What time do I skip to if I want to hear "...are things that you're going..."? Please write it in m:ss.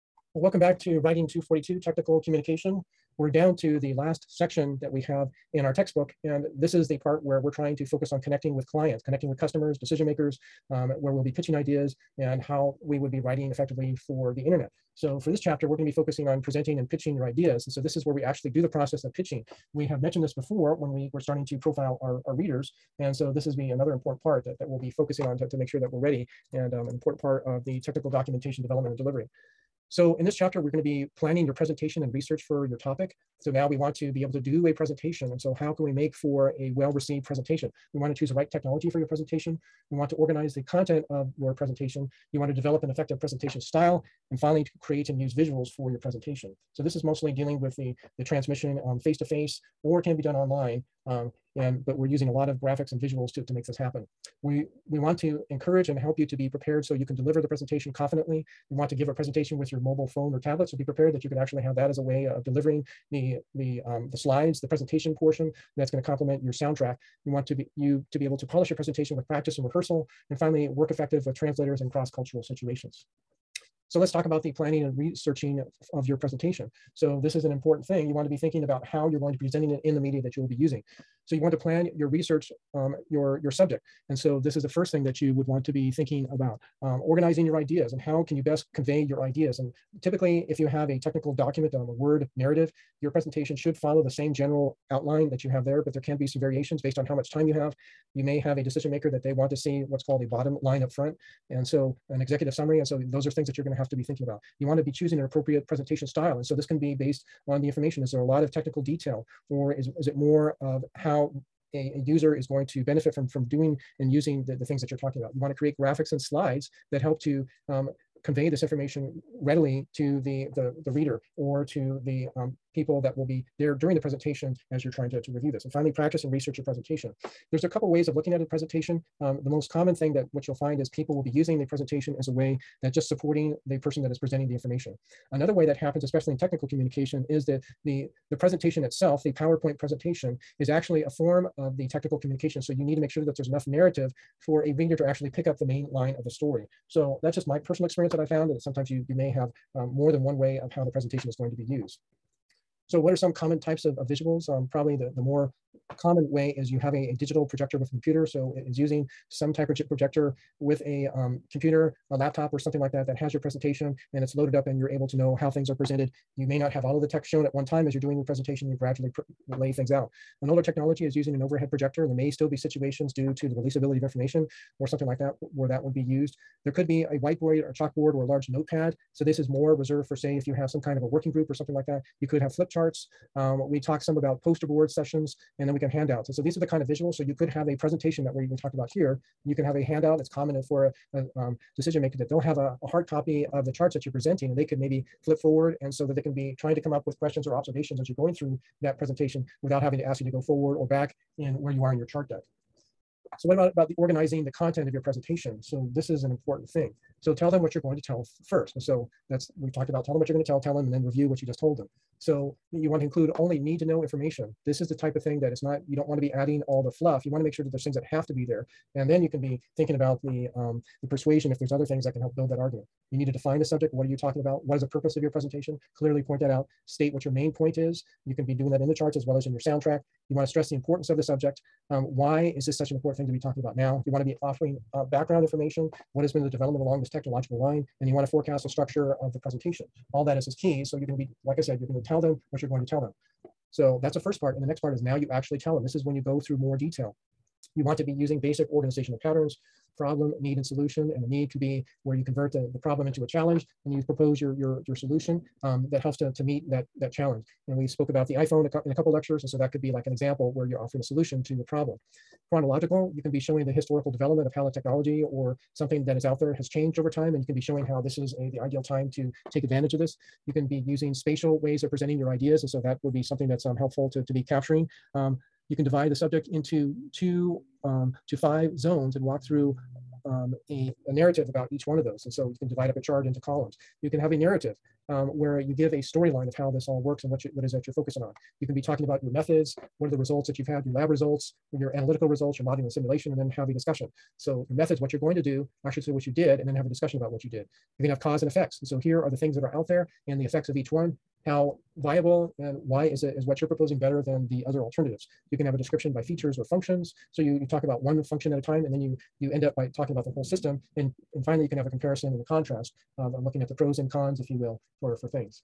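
1:43.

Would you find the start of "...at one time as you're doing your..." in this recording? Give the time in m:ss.
2:47.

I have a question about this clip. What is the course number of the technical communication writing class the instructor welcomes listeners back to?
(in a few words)
242.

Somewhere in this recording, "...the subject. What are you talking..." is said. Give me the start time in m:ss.
3:43.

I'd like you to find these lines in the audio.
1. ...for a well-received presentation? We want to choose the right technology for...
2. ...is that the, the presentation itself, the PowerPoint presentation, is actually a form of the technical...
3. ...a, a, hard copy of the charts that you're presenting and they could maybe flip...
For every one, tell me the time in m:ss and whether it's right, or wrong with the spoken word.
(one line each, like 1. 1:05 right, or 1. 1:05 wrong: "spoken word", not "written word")
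1. 0:36 right
2. 2:17 right
3. 3:12 right.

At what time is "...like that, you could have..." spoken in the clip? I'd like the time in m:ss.
3:01.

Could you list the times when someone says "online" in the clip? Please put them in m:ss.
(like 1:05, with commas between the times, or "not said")
0:50.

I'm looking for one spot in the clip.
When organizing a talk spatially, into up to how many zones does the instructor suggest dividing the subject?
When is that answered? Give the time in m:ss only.
4:38.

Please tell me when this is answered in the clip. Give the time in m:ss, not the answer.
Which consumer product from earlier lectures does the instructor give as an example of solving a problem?
4:18.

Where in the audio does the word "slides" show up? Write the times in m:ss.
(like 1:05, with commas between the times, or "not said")
1:04, 1:56.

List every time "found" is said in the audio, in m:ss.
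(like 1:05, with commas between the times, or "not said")
2:28.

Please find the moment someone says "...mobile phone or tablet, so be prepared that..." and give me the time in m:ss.
0:59.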